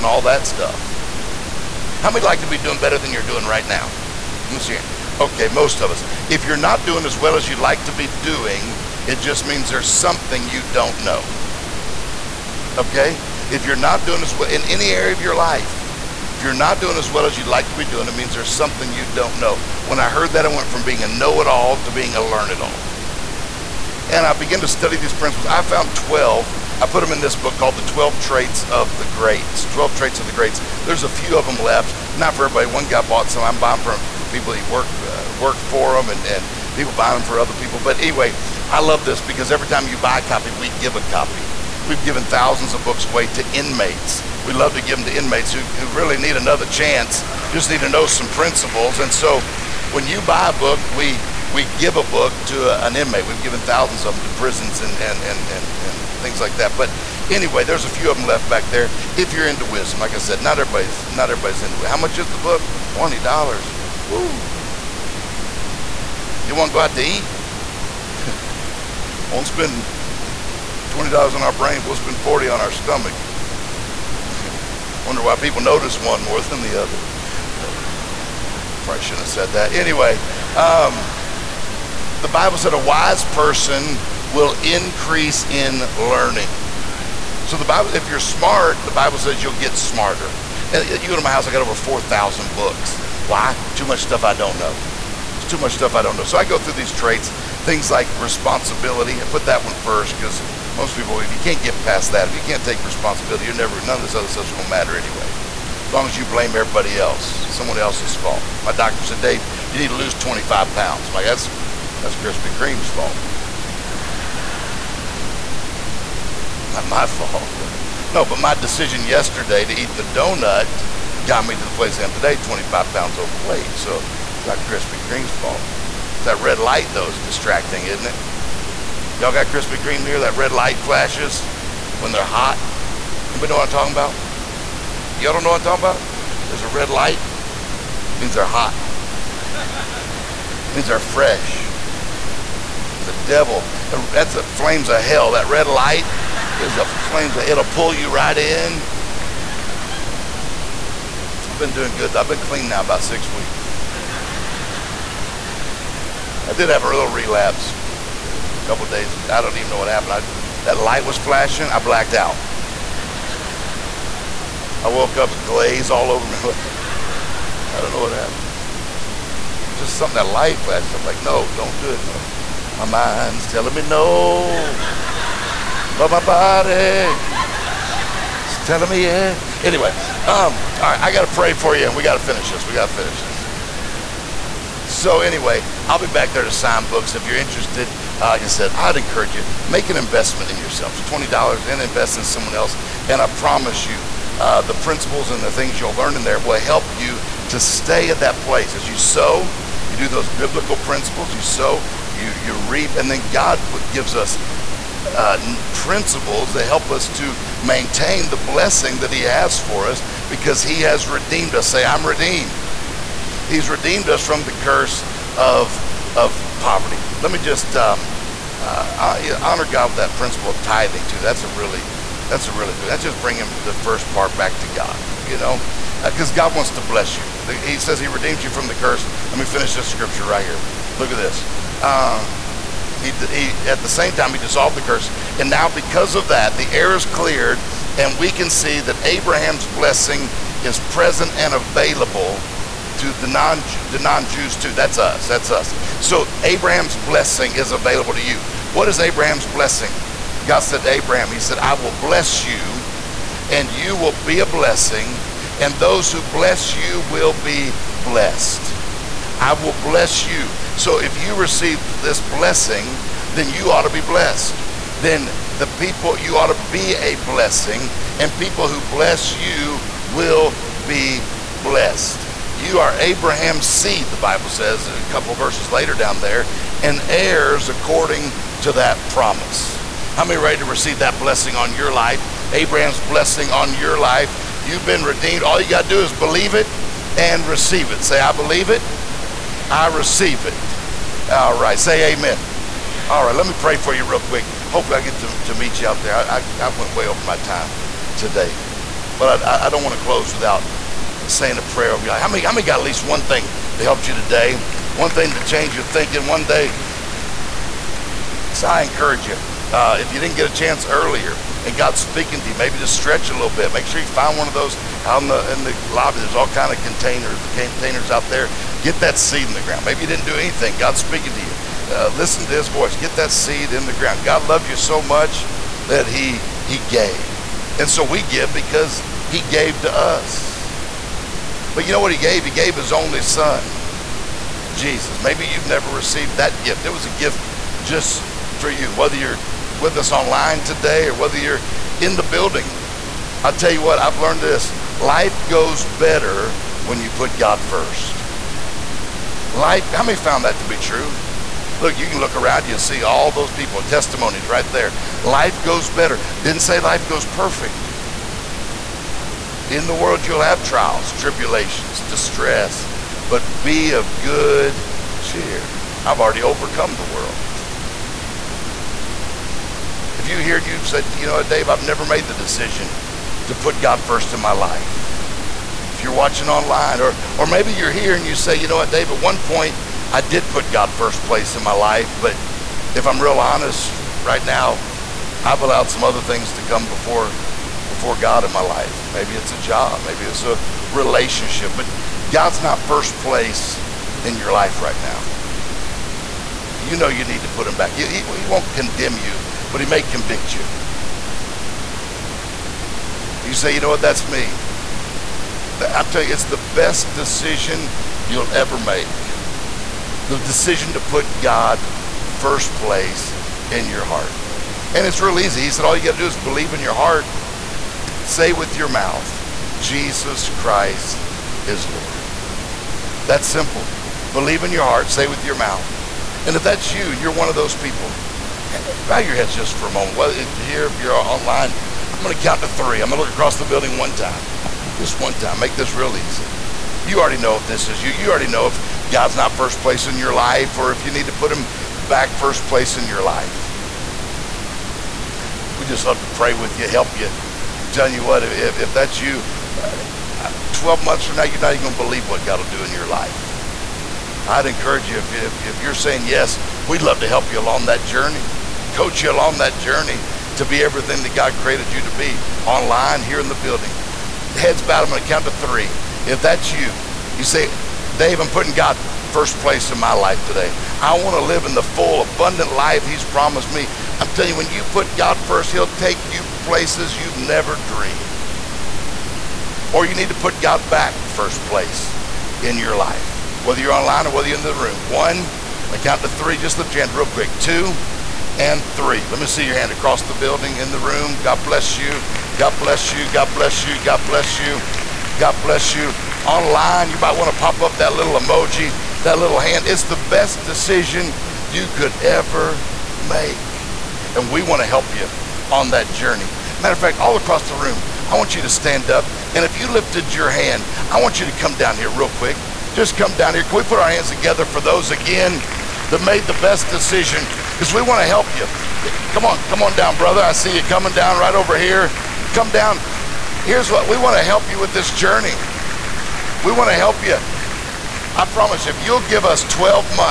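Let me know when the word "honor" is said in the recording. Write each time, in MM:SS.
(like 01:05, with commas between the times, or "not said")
03:39.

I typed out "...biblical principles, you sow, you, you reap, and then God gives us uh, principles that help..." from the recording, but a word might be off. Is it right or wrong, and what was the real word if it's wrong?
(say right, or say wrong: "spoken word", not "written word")
right.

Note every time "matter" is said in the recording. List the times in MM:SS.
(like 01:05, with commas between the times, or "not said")
01:44, 08:26.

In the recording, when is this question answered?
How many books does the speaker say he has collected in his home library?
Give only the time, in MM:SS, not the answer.
01:31.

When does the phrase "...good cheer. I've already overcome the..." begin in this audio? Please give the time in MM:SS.
06:04.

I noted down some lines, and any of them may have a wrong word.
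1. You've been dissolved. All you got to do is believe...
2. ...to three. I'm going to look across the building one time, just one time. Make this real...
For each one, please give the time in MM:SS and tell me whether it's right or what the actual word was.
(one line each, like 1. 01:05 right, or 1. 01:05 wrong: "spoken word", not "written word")
1. 04:44 wrong: "redeemed", not "dissolved"
2. 07:12 right.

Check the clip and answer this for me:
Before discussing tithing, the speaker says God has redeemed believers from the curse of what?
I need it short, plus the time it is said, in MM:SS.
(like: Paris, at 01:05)
poverty, at 03:36.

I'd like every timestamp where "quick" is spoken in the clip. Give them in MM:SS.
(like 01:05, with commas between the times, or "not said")
04:54, 08:07, 08:32.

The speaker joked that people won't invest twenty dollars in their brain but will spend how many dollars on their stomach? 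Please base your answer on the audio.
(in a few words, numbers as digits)
40.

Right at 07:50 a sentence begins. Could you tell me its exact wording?
I want to live in the full, abundant life He's promised me.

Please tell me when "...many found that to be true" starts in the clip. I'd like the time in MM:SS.
05:50.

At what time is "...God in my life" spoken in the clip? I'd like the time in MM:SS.
06:28.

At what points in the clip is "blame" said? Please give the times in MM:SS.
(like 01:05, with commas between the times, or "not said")
01:46.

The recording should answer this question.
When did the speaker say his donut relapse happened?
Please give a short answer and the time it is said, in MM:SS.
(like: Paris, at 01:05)
a couple days ago, at 02:38.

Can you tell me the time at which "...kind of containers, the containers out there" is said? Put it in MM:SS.
05:16.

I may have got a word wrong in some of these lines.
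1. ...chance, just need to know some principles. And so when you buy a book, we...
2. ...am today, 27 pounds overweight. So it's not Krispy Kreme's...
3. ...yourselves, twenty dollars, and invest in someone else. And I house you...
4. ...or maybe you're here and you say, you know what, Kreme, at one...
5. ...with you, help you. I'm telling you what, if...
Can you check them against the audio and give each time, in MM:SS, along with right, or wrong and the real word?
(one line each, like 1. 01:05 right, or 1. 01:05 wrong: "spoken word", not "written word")
1. 00:46 right
2. 02:02 wrong: "25", not "27"
3. 03:10 wrong: "promise", not "house"
4. 06:17 wrong: "Dave", not "Kreme"
5. 07:26 right.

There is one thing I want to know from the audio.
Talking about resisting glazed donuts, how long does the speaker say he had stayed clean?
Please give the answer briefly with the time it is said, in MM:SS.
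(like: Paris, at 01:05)
about six weeks, at 02:32.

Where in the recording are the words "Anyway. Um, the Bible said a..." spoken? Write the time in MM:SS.
01:19.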